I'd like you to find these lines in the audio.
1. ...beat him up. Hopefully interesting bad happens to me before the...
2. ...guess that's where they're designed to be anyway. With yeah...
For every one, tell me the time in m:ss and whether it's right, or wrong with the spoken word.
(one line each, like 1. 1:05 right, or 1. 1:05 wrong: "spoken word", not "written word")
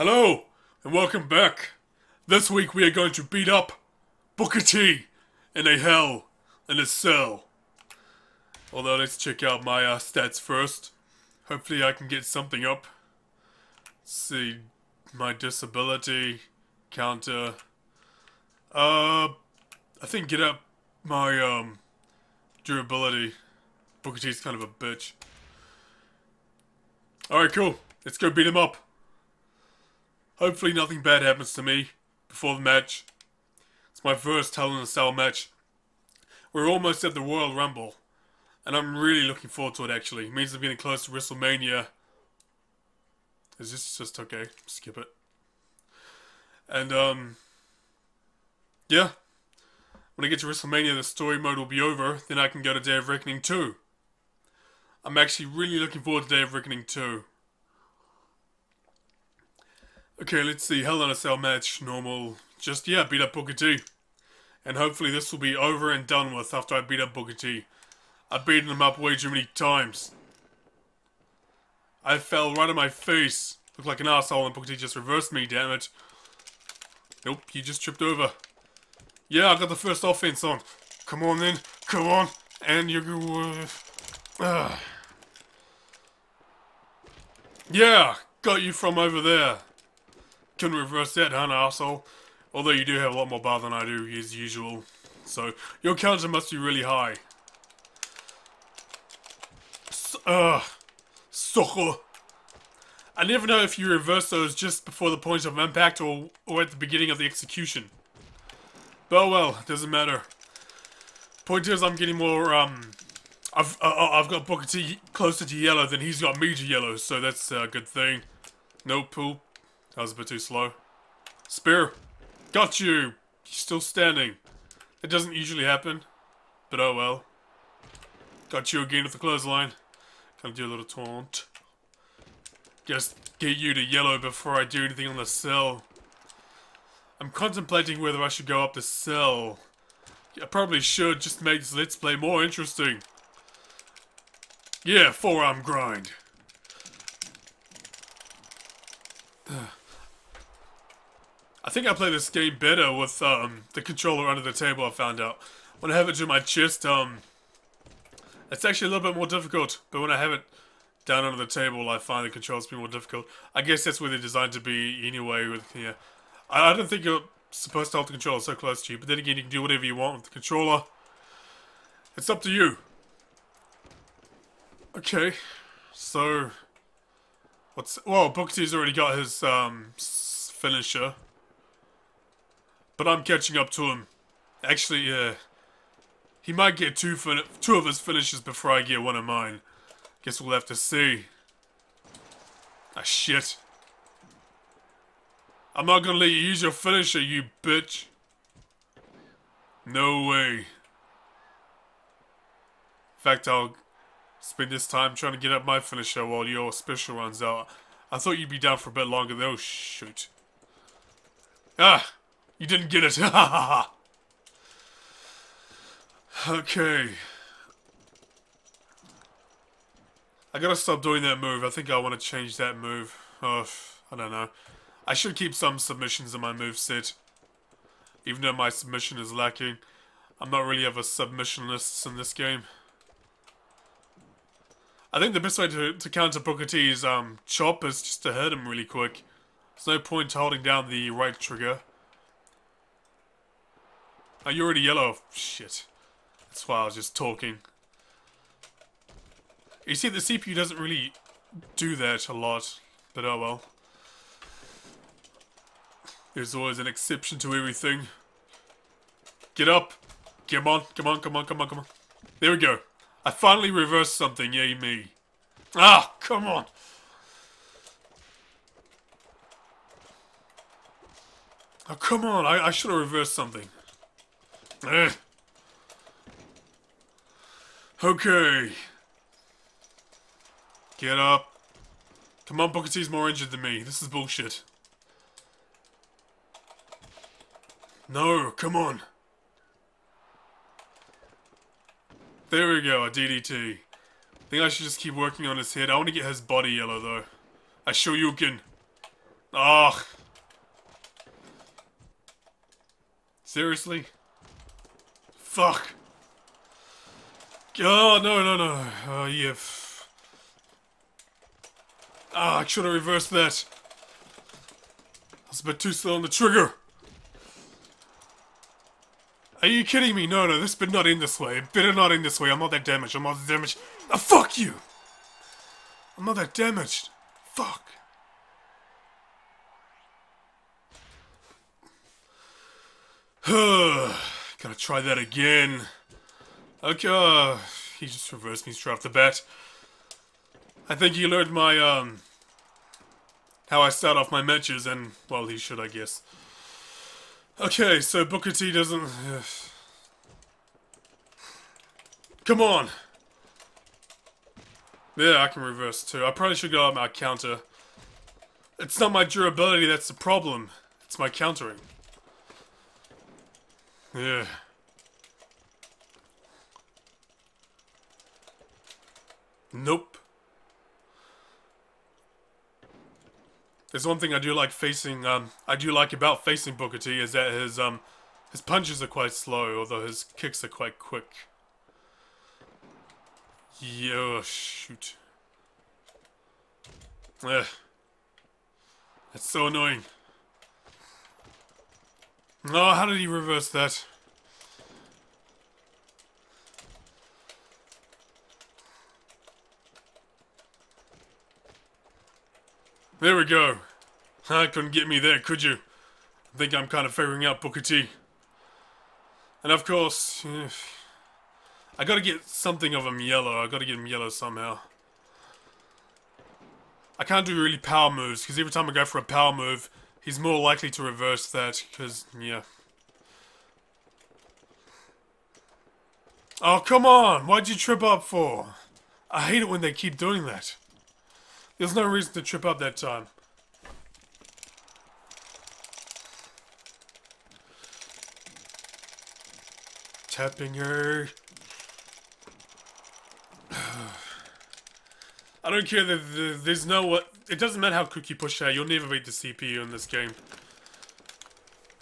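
1. 0:28 wrong: "nothing", not "interesting"
2. 2:43 right.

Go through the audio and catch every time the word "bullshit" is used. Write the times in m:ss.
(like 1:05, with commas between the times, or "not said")
4:44.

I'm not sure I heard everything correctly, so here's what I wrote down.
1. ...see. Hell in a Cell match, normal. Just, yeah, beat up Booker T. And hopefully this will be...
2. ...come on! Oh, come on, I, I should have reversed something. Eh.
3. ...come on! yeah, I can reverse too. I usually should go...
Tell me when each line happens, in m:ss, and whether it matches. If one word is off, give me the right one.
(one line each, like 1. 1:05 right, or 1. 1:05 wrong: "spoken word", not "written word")
1. 1:00 right
2. 4:26 right
3. 5:52 wrong: "probably", not "usually".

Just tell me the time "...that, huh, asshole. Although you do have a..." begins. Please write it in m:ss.
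1:31.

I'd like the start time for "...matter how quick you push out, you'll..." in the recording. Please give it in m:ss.
7:27.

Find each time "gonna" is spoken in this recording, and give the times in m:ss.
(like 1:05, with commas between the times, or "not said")
2:10, 3:16.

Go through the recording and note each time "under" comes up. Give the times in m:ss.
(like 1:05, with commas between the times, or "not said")
2:34, 2:41.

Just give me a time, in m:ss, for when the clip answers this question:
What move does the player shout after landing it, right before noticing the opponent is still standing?
2:01.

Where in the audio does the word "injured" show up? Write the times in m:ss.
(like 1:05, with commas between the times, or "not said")
4:43.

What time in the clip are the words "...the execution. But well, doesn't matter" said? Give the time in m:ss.
1:47.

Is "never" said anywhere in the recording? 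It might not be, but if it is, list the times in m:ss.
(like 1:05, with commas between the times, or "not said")
1:43, 7:28.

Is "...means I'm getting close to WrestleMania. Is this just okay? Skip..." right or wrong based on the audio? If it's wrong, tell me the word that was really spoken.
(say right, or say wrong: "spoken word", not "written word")
right.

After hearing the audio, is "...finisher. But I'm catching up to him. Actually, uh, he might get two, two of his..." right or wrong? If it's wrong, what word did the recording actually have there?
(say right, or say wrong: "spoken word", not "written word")
right.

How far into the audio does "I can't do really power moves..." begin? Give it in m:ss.
6:57.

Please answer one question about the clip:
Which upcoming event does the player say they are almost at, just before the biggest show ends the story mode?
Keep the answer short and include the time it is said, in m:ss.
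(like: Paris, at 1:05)
Royal Rumble, at 0:37.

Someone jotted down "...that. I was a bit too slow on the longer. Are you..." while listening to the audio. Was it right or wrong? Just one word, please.
wrong.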